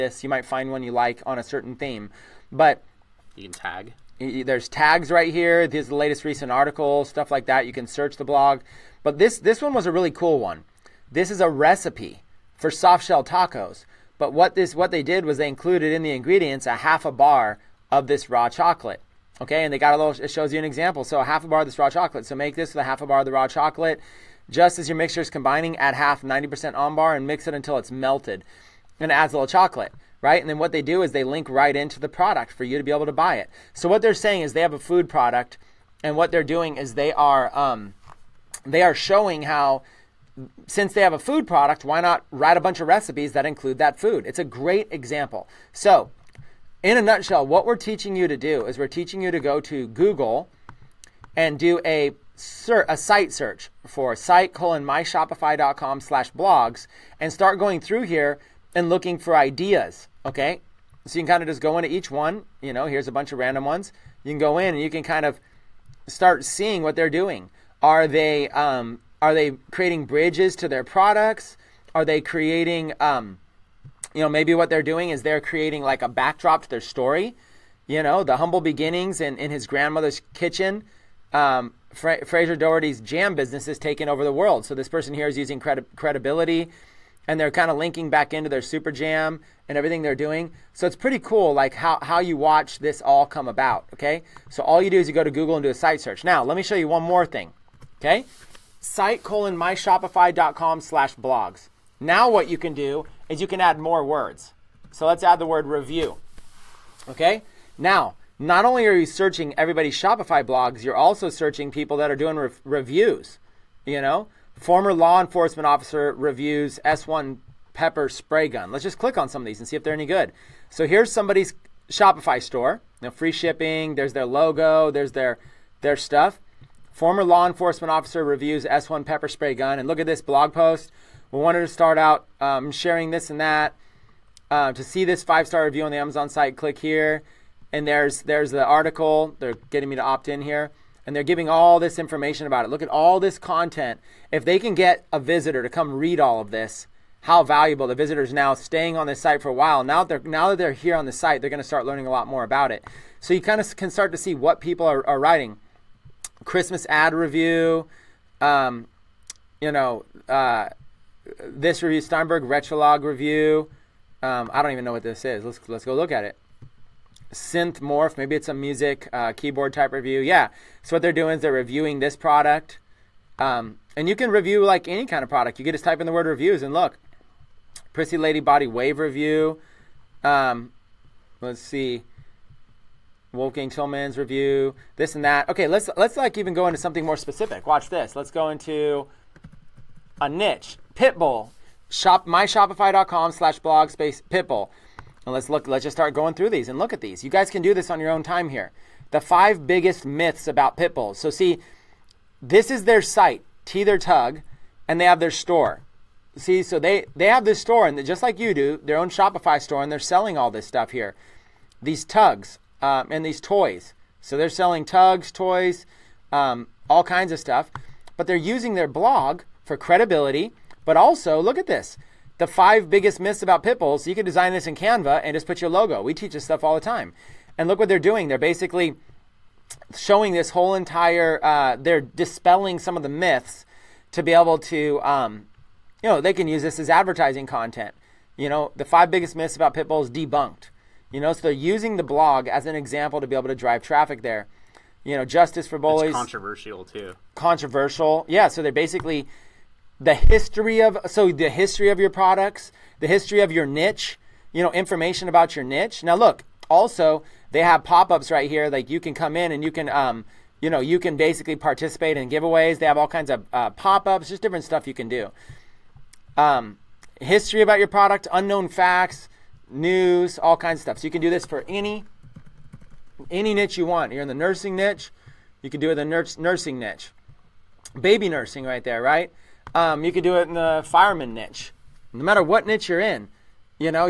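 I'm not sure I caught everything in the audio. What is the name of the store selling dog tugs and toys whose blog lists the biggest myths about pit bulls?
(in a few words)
Tether Tug.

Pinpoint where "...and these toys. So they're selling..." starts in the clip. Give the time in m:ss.
3:33.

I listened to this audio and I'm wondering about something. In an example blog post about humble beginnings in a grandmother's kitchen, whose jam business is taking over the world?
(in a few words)
Fraser Doherty.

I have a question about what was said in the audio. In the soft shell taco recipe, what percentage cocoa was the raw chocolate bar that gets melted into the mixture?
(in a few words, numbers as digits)
90%.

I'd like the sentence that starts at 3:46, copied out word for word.
We teach this stuff all the time.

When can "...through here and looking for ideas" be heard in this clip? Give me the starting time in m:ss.
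0:57.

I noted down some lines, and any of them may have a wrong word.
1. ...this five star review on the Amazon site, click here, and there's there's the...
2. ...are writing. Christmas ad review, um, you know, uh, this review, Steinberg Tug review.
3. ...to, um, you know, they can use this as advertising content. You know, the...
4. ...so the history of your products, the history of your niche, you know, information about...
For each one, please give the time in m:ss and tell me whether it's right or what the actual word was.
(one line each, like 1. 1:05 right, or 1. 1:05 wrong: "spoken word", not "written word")
1. 2:15 right
2. 2:35 wrong: "Retrologue", not "Tug"
3. 3:54 right
4. 4:11 right.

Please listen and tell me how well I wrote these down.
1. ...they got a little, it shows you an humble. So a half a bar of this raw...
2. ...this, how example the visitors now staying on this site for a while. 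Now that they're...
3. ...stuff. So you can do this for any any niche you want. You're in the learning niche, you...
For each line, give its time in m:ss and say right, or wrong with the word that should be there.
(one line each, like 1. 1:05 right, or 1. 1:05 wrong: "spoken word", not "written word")
1. 0:19 wrong: "example", not "humble"
2. 2:26 wrong: "valuable", not "example"
3. 4:30 wrong: "nursing", not "learning".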